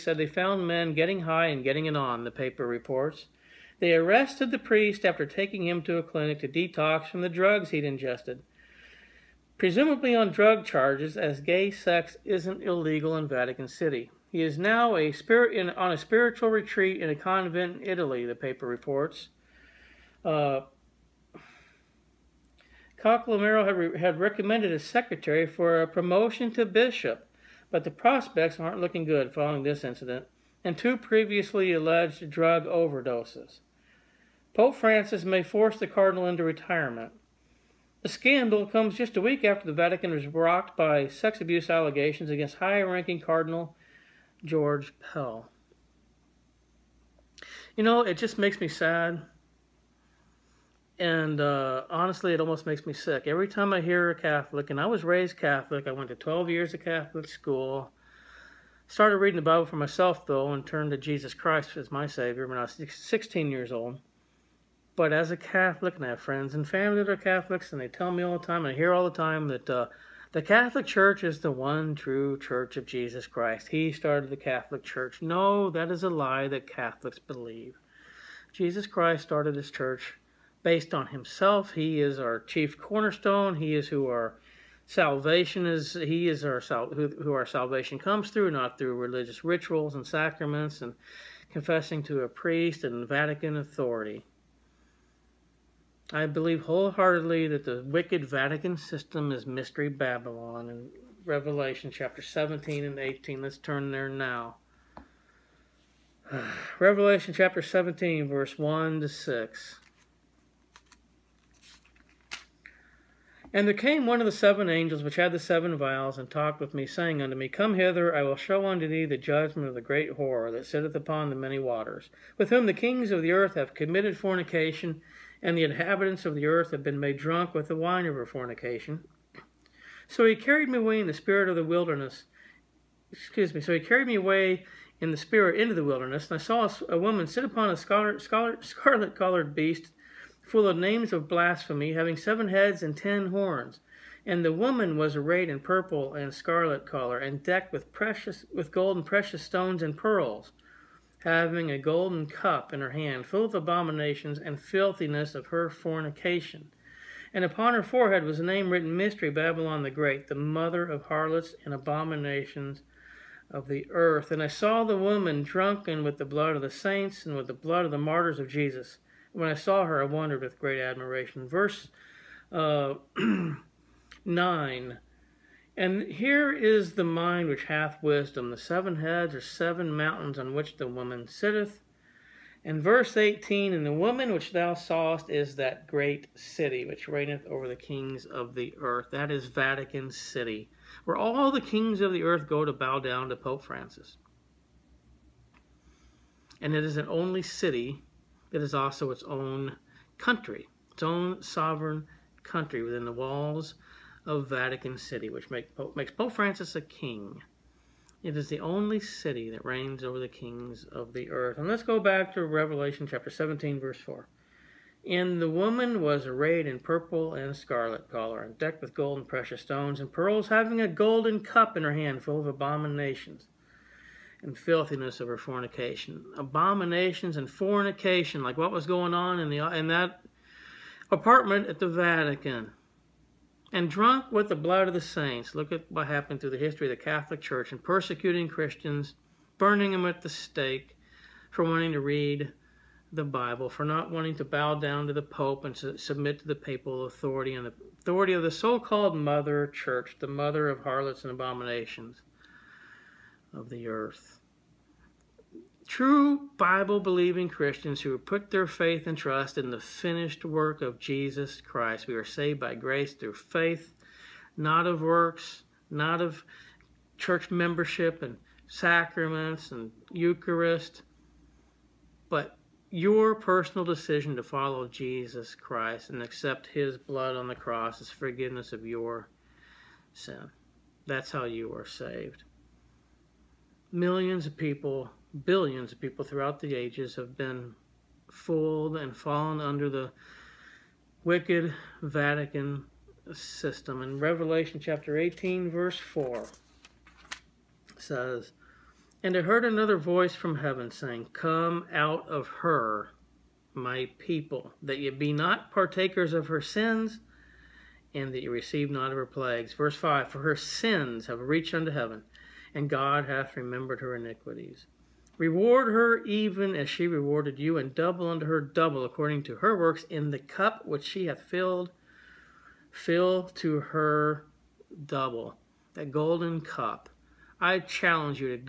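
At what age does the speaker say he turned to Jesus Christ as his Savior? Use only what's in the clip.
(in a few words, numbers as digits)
16.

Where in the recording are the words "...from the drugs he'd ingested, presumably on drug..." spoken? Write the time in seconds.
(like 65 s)
7 s.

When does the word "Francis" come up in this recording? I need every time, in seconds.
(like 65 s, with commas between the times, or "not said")
34 s, 193 s, 206 s.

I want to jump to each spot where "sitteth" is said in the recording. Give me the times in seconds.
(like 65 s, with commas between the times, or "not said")
120 s, 181 s.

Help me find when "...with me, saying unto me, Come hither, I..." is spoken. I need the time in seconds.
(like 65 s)
116 s.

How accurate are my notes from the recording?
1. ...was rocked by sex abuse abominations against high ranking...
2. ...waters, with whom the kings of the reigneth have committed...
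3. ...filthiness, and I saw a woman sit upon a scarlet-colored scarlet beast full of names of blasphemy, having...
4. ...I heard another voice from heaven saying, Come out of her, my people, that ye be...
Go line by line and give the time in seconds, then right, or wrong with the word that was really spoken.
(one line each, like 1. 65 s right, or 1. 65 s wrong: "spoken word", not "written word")
1. 40 s wrong: "allegations", not "abominations"
2. 121 s wrong: "earth", not "reigneth"
3. 135 s wrong: "wilderness", not "filthiness"
4. 299 s right.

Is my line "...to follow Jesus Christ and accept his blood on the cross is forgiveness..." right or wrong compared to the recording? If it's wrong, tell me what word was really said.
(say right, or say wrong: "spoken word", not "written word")
right.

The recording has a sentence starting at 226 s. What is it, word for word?
Abominations and fornication, like what was going on in, the, in that apartment at the Vatican.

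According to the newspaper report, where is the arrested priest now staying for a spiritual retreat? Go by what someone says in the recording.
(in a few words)
A convent in Italy.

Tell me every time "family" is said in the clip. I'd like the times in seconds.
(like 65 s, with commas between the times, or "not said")
66 s.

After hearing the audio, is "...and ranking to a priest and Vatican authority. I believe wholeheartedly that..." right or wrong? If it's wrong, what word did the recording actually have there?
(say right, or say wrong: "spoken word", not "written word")
wrong: "confessing", not "ranking".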